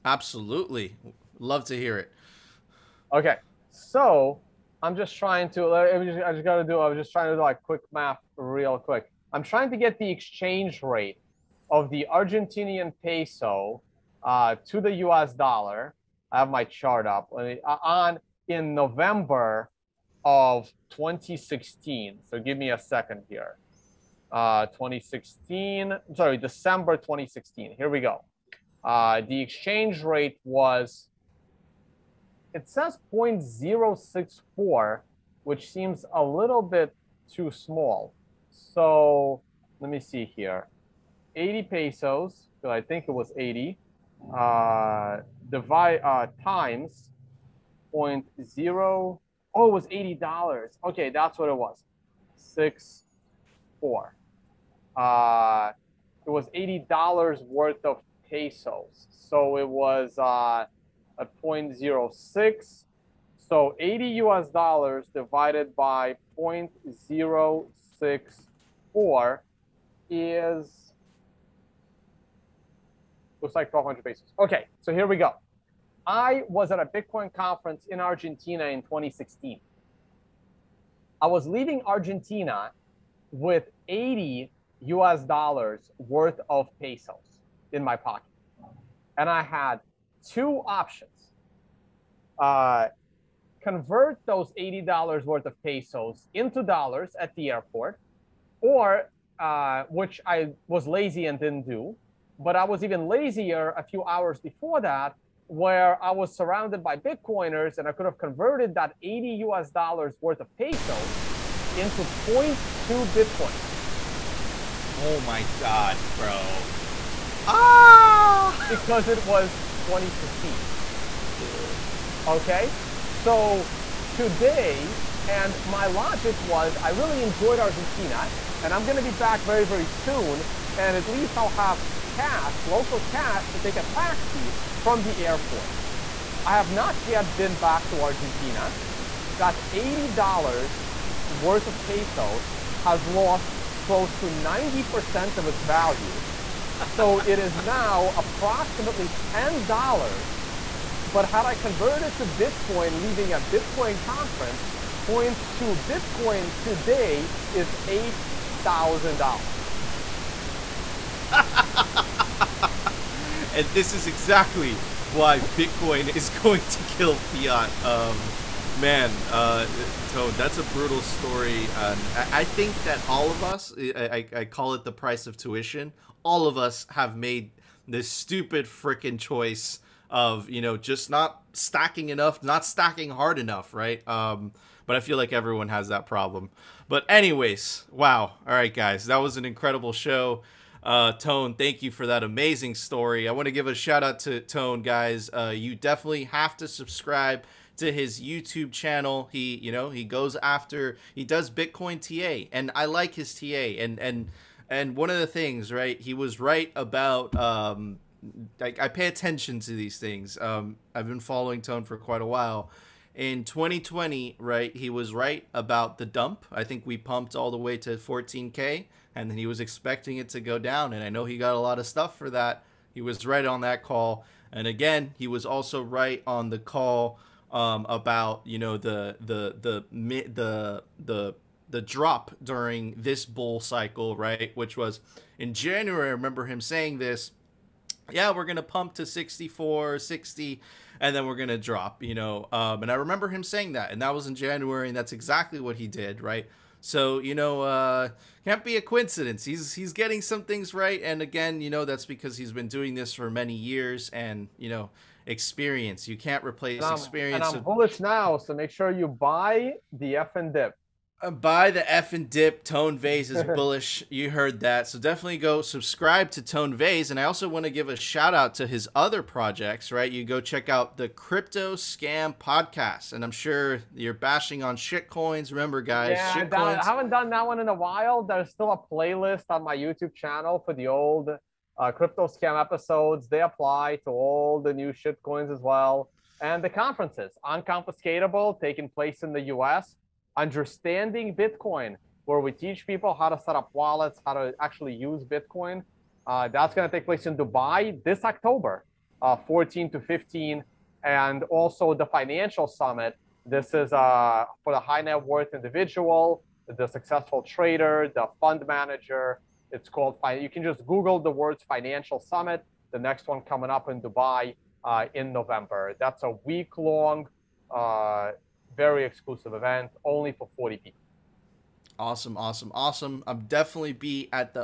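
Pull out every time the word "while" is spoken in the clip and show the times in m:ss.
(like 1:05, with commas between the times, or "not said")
3:32, 4:37.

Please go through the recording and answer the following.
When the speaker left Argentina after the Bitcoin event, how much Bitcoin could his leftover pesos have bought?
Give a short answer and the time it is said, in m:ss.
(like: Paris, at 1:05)
0.2 Bitcoin, at 1:52.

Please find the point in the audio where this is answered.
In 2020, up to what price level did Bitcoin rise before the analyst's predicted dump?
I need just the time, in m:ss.
3:37.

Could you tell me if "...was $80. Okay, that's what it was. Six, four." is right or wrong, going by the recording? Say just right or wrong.
right.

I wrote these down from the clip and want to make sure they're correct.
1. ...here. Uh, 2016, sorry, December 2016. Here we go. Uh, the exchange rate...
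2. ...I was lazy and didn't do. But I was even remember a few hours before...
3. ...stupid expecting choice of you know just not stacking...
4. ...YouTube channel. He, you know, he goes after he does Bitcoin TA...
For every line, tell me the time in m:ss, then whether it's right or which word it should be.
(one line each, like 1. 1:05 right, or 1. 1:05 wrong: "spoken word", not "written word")
1. 0:23 right
2. 1:40 wrong: "lazier", not "remember"
3. 2:58 wrong: "freaking", not "expecting"
4. 3:18 right.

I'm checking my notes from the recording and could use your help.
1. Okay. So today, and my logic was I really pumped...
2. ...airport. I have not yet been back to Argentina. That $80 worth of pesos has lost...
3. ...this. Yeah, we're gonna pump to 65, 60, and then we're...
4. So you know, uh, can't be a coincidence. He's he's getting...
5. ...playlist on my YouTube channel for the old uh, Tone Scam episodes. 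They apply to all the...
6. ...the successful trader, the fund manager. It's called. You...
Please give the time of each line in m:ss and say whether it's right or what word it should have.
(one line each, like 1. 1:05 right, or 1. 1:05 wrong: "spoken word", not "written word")
1. 2:02 wrong: "enjoyed", not "pumped"
2. 2:15 right
3. 3:56 wrong: "64", not "65"
4. 4:06 right
5. 4:38 wrong: "Crypto", not "Tone"
6. 5:06 right.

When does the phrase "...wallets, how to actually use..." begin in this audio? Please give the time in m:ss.
4:53.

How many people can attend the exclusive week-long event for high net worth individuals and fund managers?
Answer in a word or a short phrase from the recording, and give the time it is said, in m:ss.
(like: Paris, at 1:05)
40, at 5:20.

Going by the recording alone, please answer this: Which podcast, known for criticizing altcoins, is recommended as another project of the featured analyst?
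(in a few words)
Crypto Scam Podcast.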